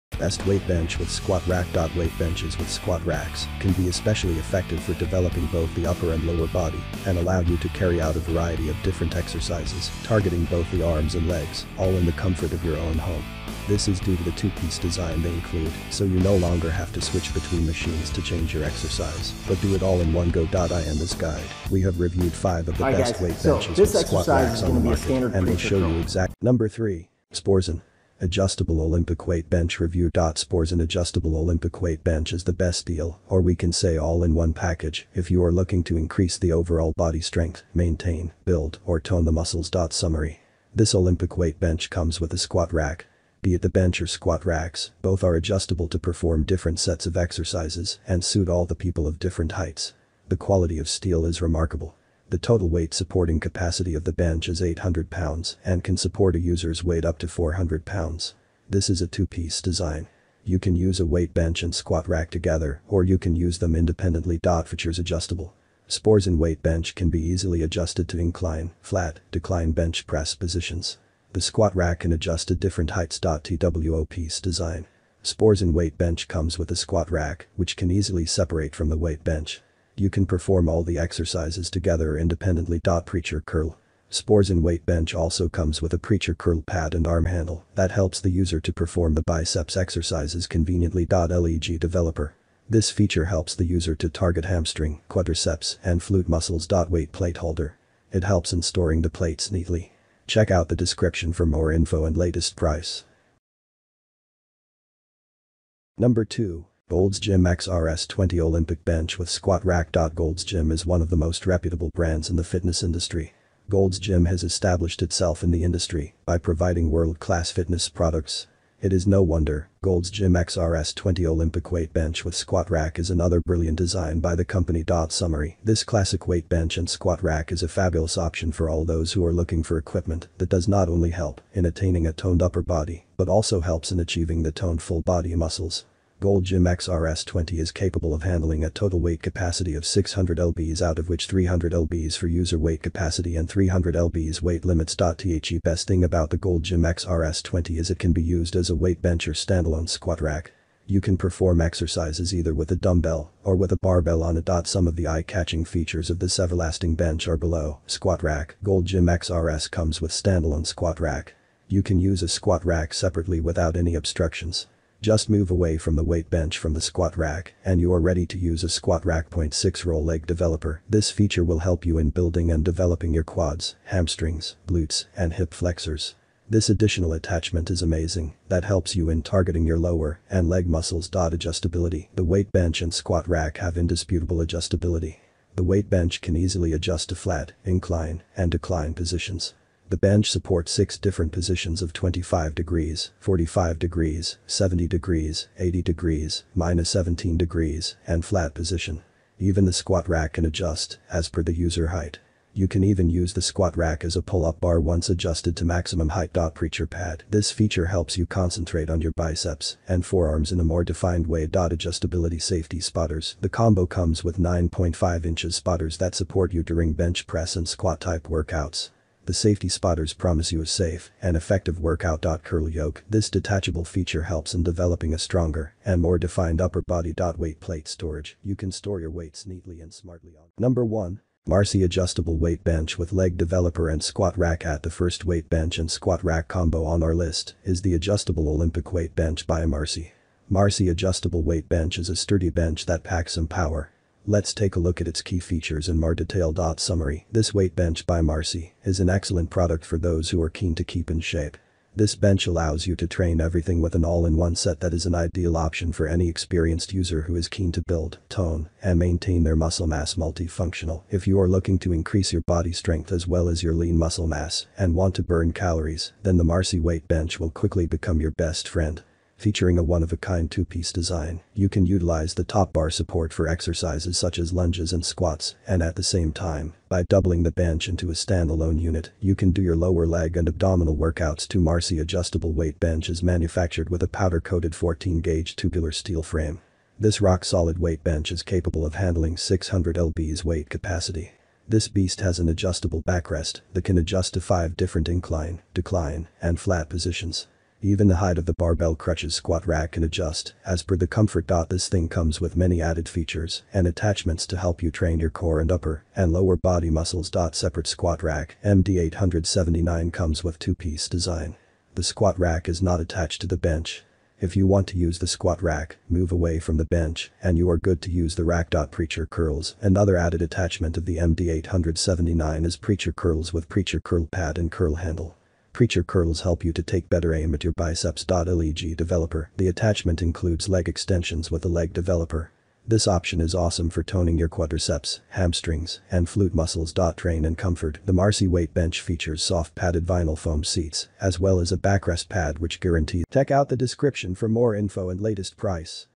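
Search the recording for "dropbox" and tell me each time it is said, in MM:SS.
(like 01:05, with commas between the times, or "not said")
not said.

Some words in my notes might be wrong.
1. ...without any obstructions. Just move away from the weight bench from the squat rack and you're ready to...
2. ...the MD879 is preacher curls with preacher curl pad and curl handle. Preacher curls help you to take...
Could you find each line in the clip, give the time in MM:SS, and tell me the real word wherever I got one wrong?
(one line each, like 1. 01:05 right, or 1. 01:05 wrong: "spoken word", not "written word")
1. 02:43 right
2. 05:21 right.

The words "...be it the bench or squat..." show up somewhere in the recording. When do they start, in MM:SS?
00:43.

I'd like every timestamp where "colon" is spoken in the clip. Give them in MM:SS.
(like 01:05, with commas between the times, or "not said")
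not said.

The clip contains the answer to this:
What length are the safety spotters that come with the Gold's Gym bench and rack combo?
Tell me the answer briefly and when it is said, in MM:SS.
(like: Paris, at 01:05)
9.5 inches, at 03:34.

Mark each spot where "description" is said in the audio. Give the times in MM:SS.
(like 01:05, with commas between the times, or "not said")
01:40, 05:43.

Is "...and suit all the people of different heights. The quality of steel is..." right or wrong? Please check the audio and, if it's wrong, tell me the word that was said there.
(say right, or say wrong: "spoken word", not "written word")
right.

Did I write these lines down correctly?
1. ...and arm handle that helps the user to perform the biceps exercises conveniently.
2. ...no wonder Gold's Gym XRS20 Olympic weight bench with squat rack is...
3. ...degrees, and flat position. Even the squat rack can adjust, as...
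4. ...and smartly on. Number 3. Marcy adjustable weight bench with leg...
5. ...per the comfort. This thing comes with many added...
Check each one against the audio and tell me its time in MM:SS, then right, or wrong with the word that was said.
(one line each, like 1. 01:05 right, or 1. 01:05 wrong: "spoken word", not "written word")
1. 01:26 right
2. 01:59 right
3. 03:17 right
4. 03:49 wrong: "1", not "3"
5. 05:00 right.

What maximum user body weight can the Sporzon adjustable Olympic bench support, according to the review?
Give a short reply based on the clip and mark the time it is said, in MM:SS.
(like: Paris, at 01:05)
400 pounds, at 00:57.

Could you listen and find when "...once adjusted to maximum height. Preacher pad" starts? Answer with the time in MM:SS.
03:24.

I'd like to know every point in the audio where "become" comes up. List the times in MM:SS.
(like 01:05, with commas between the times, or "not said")
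04:27.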